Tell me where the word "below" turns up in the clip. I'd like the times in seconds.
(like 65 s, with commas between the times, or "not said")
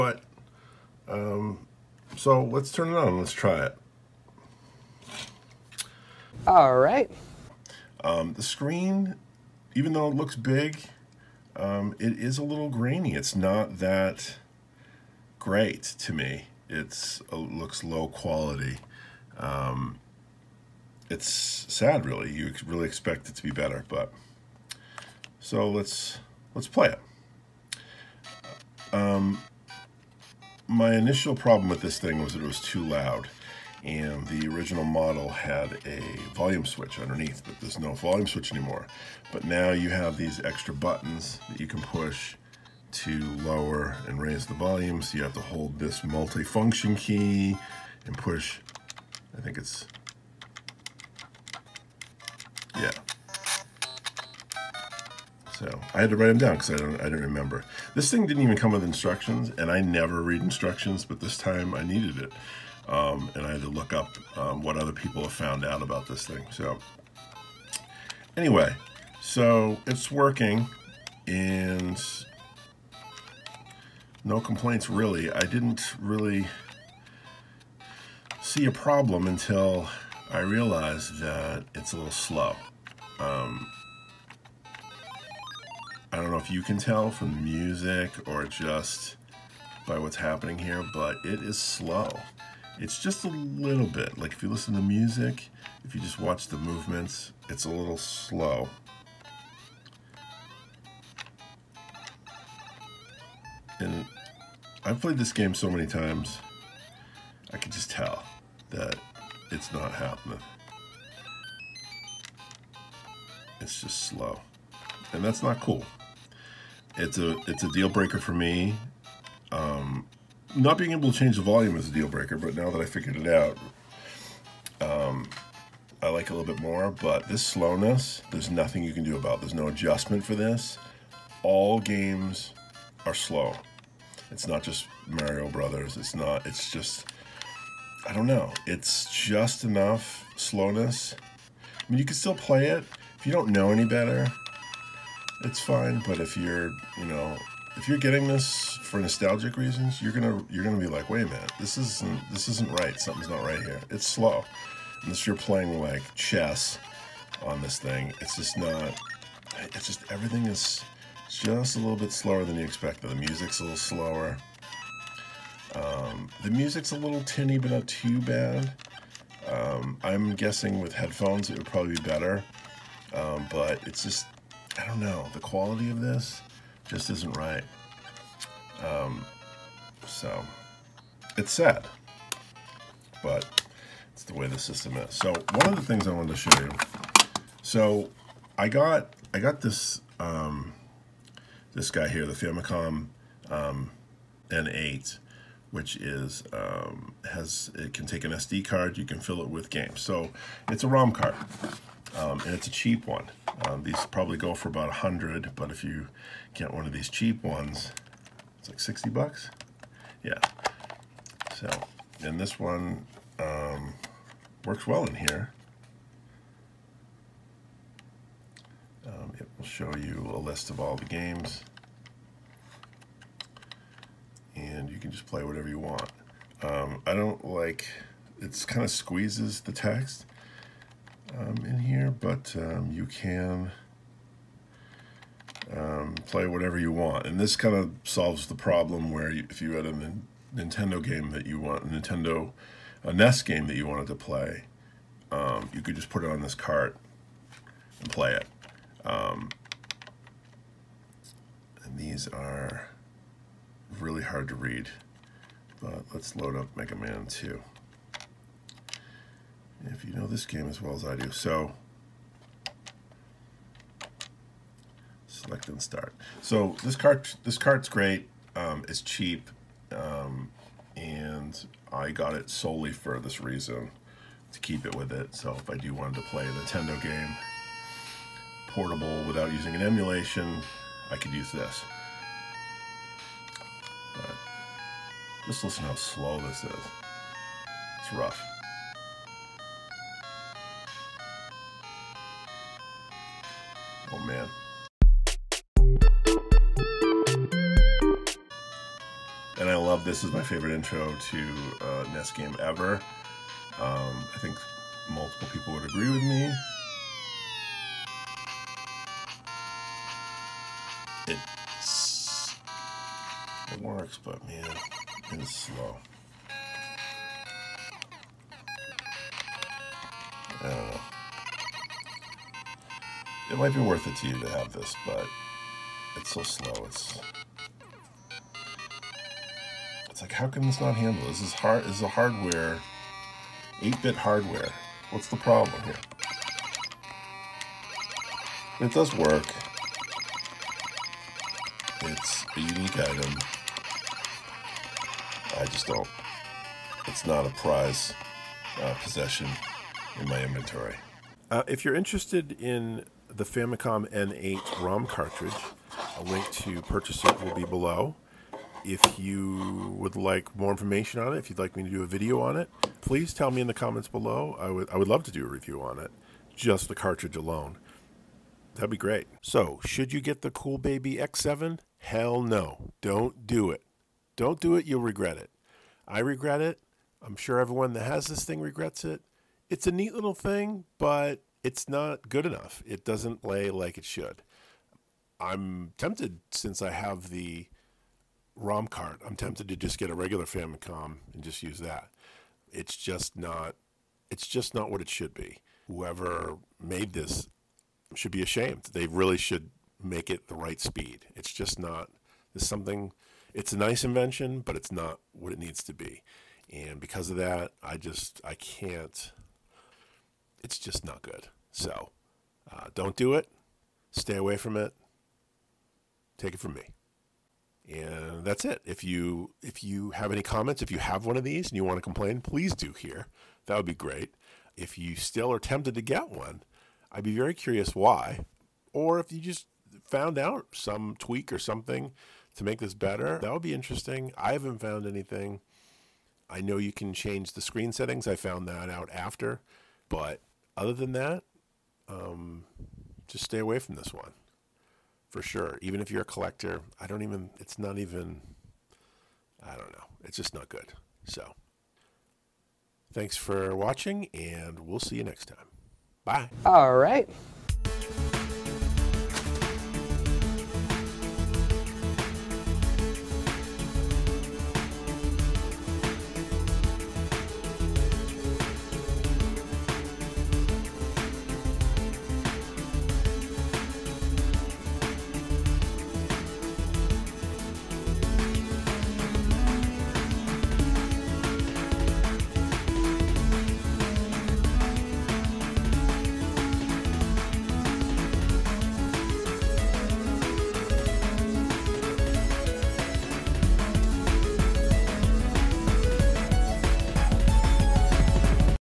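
357 s, 364 s.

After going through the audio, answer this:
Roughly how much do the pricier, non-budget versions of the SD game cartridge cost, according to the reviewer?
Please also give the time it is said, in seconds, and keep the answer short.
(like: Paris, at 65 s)
About 100, at 204 s.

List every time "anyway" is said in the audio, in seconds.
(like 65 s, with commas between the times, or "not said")
68 s.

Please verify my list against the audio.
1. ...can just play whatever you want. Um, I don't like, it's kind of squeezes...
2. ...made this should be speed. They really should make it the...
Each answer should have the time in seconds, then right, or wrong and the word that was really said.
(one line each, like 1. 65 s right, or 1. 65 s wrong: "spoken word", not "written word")
1. 224 s right
2. 396 s wrong: "ashamed", not "speed".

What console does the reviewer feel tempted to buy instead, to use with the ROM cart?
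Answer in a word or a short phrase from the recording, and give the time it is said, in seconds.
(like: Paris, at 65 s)
A regular Famicom, at 390 s.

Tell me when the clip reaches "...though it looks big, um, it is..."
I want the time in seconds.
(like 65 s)
9 s.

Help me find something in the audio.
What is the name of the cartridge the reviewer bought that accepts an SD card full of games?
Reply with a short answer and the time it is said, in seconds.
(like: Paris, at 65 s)
Famicom N8, at 192 s.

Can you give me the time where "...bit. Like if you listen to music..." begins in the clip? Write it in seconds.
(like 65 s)
93 s.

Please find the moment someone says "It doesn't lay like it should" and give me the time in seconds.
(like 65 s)
382 s.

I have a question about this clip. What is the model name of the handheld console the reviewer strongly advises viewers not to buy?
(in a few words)
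Cool Baby X7.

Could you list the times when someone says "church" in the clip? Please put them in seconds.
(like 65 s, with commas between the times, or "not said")
not said.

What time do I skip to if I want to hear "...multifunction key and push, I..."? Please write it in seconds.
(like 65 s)
46 s.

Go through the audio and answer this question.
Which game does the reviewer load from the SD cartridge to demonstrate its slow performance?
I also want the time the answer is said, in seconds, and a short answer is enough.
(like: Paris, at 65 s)
Mega Man 2, at 256 s.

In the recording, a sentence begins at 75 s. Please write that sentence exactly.
I didn't really see a problem until I realized that it's a little slow.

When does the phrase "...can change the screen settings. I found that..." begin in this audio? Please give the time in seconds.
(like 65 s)
436 s.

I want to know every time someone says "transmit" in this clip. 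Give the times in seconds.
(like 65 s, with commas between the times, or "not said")
not said.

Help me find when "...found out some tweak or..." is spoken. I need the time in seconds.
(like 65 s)
430 s.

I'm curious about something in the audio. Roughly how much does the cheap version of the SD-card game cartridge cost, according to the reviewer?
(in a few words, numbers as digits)
$60.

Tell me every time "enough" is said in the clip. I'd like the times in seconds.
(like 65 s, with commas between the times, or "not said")
139 s, 382 s.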